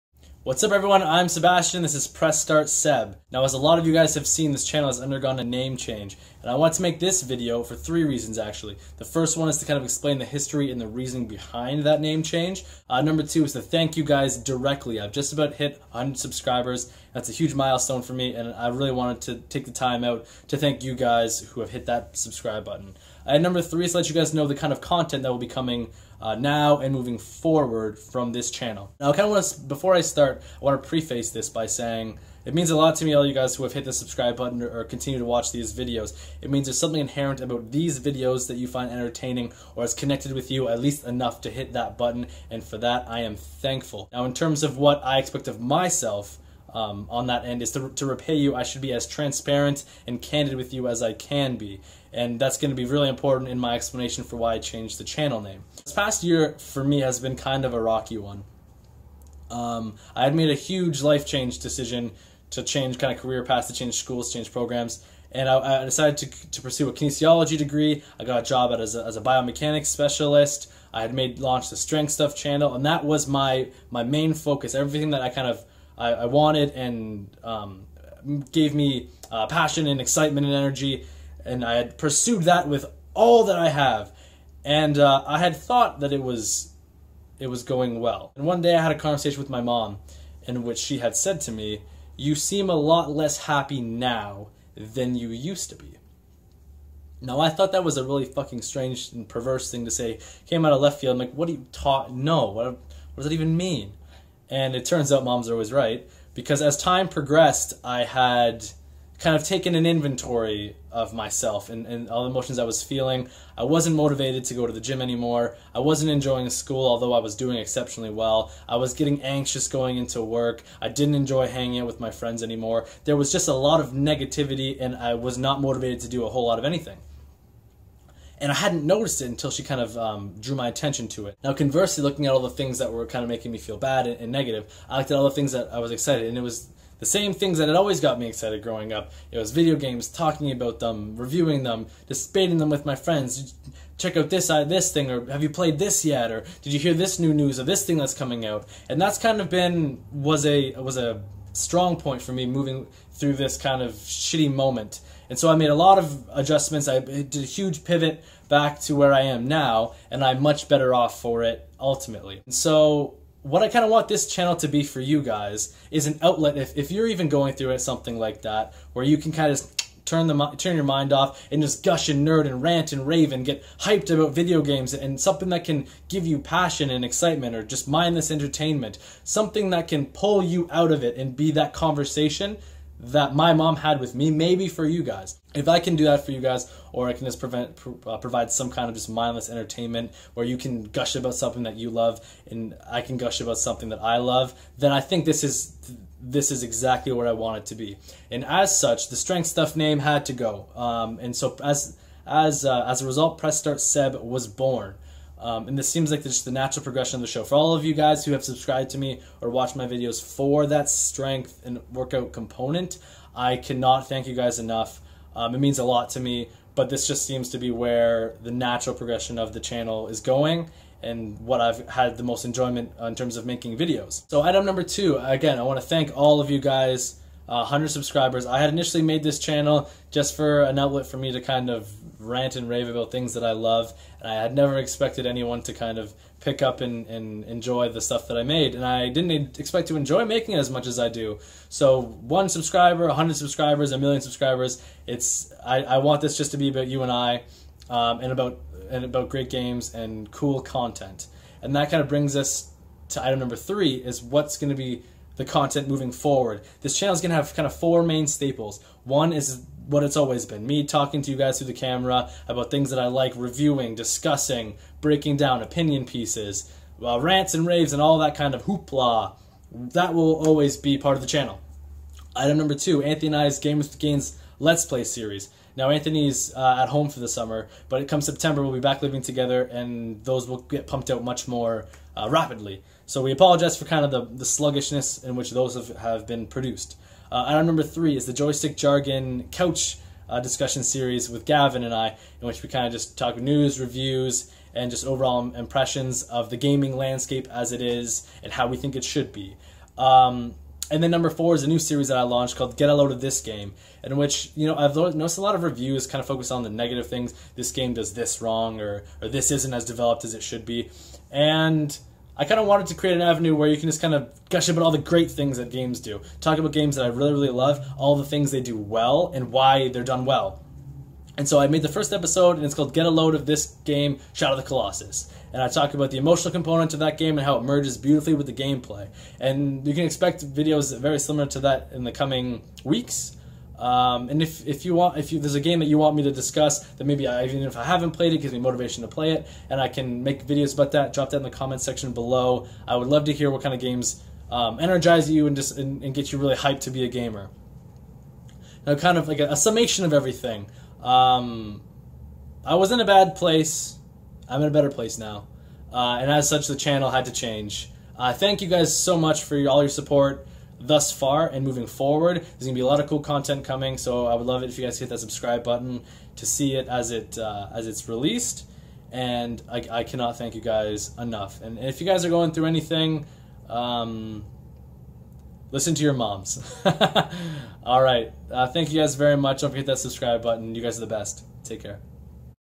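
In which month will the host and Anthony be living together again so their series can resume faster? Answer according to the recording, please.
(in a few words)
September.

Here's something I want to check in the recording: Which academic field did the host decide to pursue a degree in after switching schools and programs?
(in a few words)
Kinesiology.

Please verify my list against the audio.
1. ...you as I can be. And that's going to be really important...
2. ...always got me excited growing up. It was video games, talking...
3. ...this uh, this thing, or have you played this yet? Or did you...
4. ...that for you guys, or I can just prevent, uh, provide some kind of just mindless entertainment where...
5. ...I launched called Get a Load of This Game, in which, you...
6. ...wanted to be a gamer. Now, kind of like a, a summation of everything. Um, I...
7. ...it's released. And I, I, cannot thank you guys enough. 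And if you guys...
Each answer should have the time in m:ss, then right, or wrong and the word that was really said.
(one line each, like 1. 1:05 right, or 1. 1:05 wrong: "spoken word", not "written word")
1. 0:50 right
2. 2:17 right
3. 2:24 right
4. 3:06 right
5. 5:02 right
6. 5:46 wrong: "hyped", not "wanted"
7. 6:07 right.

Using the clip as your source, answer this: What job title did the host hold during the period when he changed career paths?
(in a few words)
Biomechanics specialist.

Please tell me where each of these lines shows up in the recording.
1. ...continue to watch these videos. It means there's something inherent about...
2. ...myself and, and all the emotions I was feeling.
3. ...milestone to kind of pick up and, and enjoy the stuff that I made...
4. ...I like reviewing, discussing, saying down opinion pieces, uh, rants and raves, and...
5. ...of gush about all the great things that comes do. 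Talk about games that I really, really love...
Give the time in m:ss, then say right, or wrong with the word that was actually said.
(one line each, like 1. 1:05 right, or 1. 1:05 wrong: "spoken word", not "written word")
1. 0:34 right
2. 1:51 right
3. 3:55 wrong: "anyone", not "milestone"
4. 4:22 wrong: "breaking", not "saying"
5. 5:14 wrong: "games", not "comes".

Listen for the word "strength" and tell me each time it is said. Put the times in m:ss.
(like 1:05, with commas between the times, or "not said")
1:11, 3:19, 3:30.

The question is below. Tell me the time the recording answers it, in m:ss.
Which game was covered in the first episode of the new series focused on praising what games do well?
5:24.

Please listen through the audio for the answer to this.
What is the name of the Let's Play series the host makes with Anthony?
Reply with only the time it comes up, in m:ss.
4:33.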